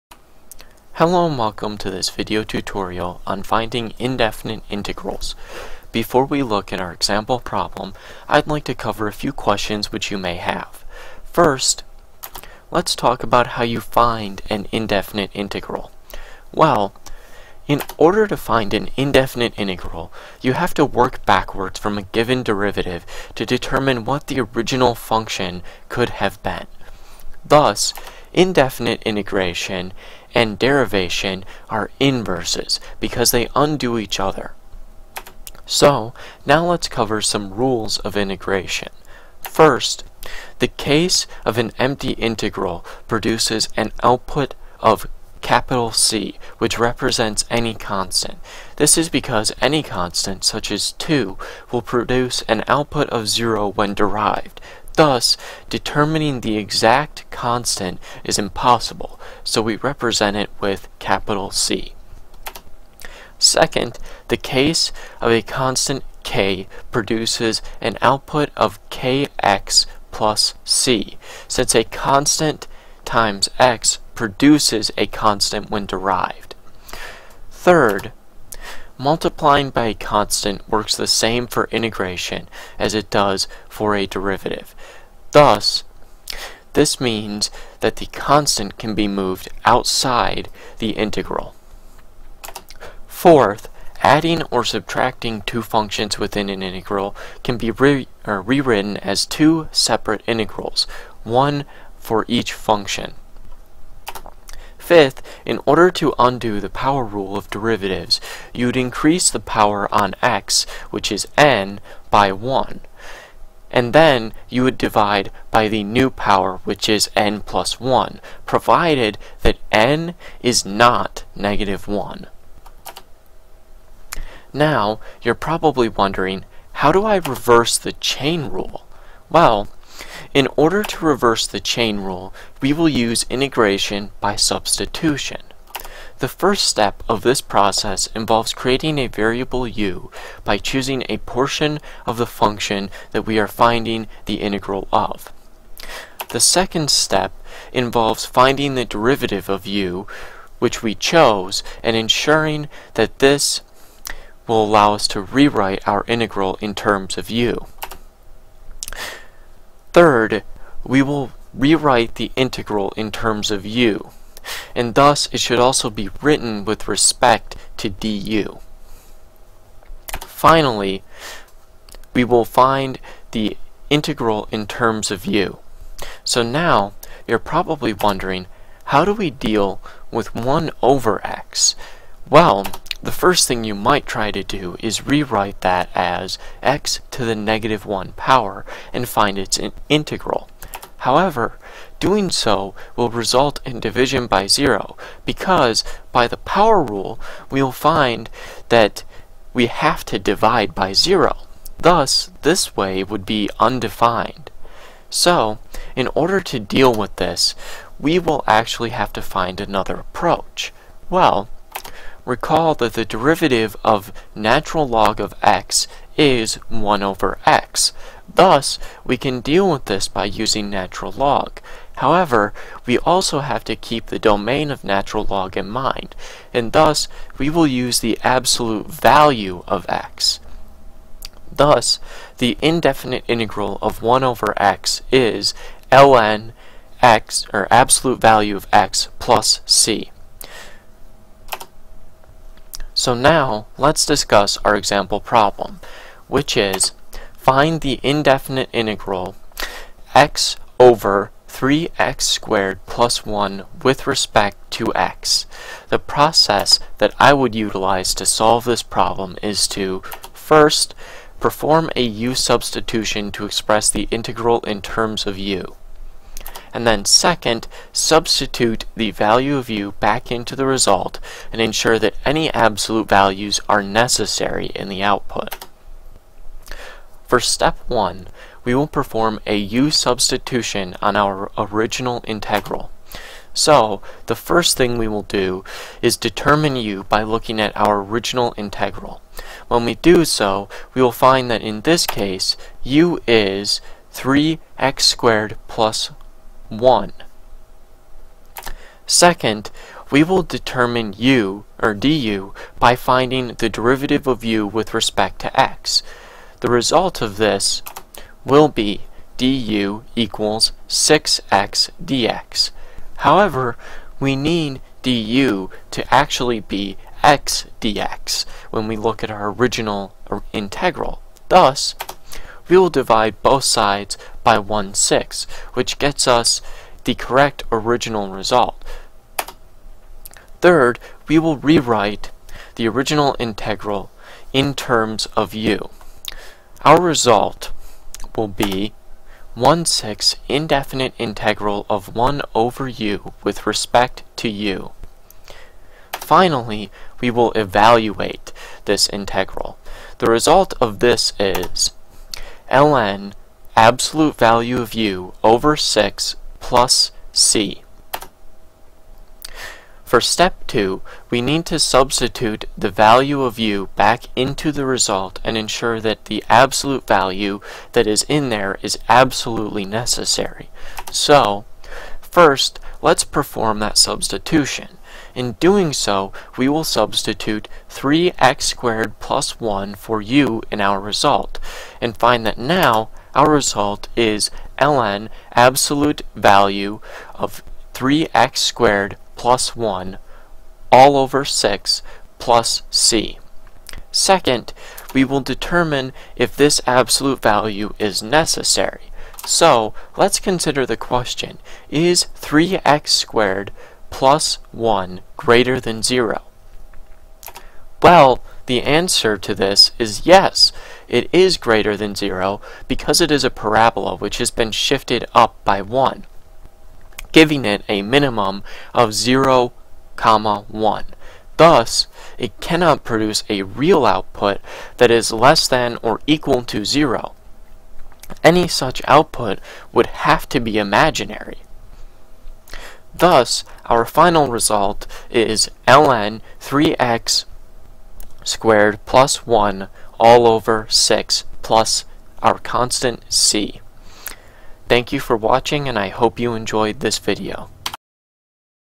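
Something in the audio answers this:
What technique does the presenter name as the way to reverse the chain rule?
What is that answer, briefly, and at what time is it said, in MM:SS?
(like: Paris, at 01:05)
integration by substitution, at 02:13.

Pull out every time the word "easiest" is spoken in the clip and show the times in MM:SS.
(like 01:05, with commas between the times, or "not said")
not said.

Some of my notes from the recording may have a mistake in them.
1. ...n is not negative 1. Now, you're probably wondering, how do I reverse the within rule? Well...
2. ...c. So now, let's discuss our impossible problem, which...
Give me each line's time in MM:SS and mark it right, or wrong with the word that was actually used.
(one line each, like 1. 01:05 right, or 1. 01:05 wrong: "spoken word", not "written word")
1. 01:59 wrong: "chain", not "within"
2. 03:59 wrong: "example", not "impossible".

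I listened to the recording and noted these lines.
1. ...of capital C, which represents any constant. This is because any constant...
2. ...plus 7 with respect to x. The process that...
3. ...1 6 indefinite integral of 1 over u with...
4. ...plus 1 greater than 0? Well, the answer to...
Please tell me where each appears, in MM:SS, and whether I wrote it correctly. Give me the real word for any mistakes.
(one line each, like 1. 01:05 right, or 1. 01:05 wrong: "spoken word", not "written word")
1. 00:44 right
2. 04:12 wrong: "1", not "7"
3. 05:39 right
4. 06:44 right.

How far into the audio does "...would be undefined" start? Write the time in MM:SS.
03:23.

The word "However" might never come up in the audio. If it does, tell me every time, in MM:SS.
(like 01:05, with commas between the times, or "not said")
03:10, 03:41, 05:13.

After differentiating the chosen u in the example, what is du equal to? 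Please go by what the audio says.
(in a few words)
6x dx.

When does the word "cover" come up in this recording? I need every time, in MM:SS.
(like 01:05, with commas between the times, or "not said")
00:08, 00:36.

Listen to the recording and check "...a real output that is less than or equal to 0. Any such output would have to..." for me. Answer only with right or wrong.
right.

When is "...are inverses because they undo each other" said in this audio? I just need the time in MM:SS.
00:31.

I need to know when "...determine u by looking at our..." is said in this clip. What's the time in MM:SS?
04:46.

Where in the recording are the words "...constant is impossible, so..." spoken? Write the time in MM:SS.
00:57.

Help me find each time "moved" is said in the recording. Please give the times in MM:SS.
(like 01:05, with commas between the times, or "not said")
01:29.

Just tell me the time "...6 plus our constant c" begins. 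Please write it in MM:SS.
07:20.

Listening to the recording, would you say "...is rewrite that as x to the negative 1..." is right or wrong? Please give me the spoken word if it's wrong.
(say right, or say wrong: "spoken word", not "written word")
right.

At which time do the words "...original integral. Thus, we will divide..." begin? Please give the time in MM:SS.
05:19.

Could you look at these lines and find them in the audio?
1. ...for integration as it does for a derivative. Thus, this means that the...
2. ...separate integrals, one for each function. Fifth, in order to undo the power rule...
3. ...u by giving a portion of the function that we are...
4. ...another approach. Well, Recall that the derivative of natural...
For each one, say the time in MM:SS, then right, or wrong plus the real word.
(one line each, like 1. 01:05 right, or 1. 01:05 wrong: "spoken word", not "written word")
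1. 01:21 right
2. 01:39 right
3. 02:19 wrong: "choosing", not "giving"
4. 03:29 right.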